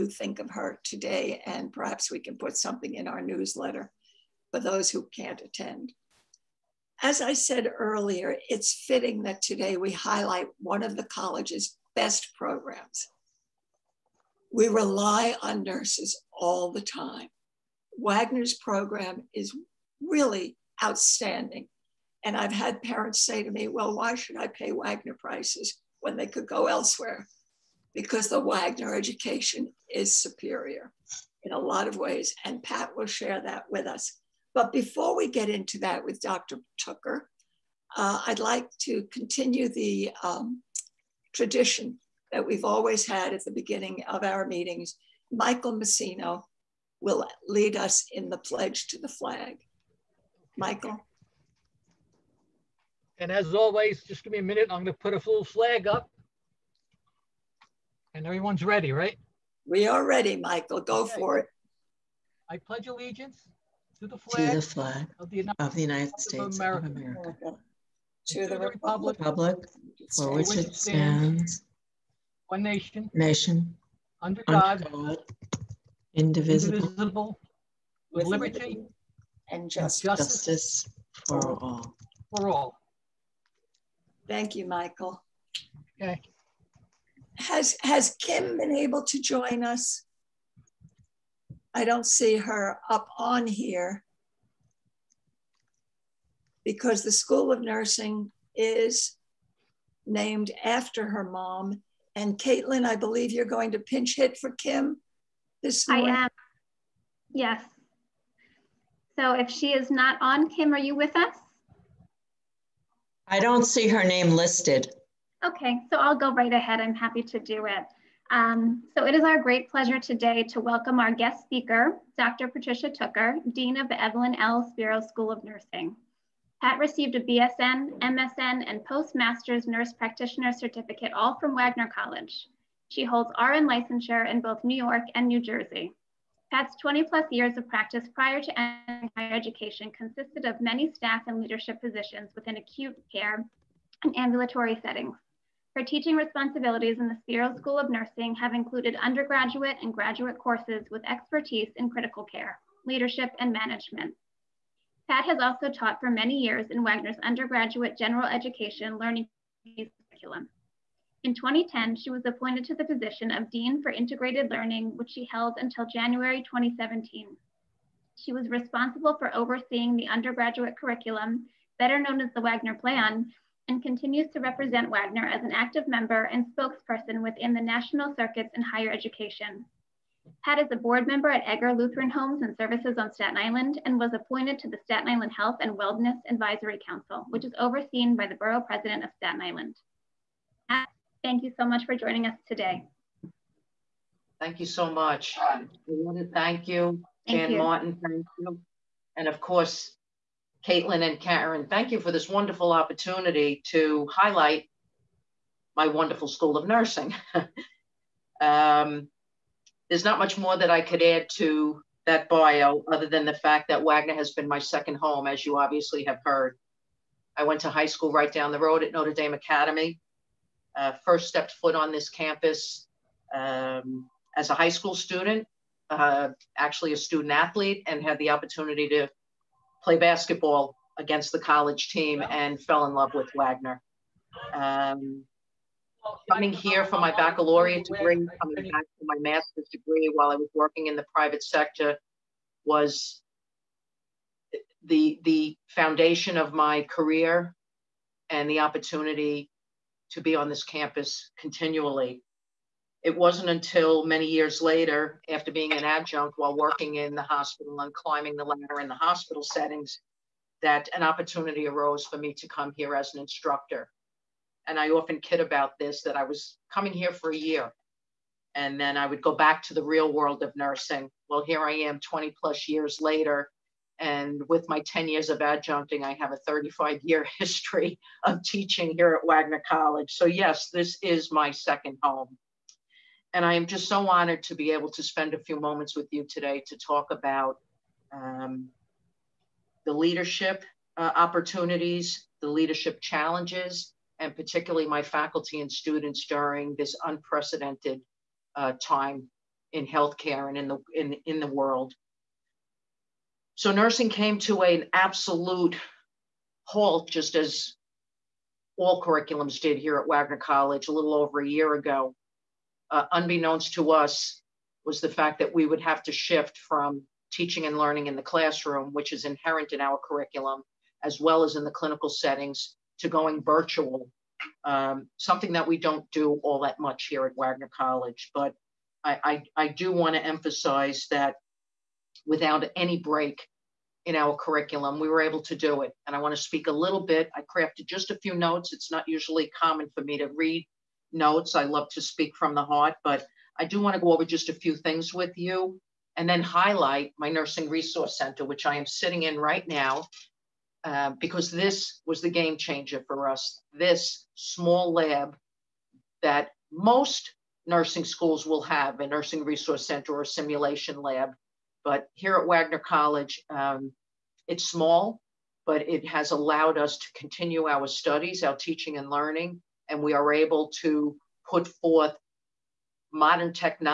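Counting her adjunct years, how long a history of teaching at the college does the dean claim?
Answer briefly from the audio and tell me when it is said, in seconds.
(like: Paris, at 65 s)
35 years, at 276 s.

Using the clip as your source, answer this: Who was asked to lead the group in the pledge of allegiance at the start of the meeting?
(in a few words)
Michael Messino.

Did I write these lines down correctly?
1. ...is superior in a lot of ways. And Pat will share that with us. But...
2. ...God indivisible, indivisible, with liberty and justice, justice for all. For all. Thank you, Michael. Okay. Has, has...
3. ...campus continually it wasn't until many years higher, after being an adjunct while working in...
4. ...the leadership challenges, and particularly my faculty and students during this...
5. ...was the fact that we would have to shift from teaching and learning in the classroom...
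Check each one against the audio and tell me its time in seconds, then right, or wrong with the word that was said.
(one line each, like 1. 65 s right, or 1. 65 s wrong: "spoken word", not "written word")
1. 29 s right
2. 74 s right
3. 250 s wrong: "later", not "higher"
4. 292 s right
5. 314 s right.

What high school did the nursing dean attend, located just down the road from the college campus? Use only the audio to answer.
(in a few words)
Notre Dame Academy.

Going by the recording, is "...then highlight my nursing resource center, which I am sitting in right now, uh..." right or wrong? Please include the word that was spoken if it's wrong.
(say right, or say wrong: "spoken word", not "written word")
right.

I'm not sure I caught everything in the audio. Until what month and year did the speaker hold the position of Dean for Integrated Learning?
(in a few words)
January 2017.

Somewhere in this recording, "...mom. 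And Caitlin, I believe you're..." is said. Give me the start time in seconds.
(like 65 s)
101 s.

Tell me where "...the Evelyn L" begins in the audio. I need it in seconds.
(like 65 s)
123 s.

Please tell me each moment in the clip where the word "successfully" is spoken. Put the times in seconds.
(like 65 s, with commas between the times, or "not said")
not said.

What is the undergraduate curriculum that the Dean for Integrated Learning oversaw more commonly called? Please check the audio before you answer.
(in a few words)
the Wagner Plan.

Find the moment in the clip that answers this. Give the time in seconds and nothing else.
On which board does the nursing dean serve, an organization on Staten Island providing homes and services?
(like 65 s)
181 s.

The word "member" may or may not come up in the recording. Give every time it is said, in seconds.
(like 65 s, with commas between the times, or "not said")
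175 s, 181 s.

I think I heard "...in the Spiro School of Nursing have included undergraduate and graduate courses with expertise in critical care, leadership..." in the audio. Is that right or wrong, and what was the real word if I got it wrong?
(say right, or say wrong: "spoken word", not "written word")
right.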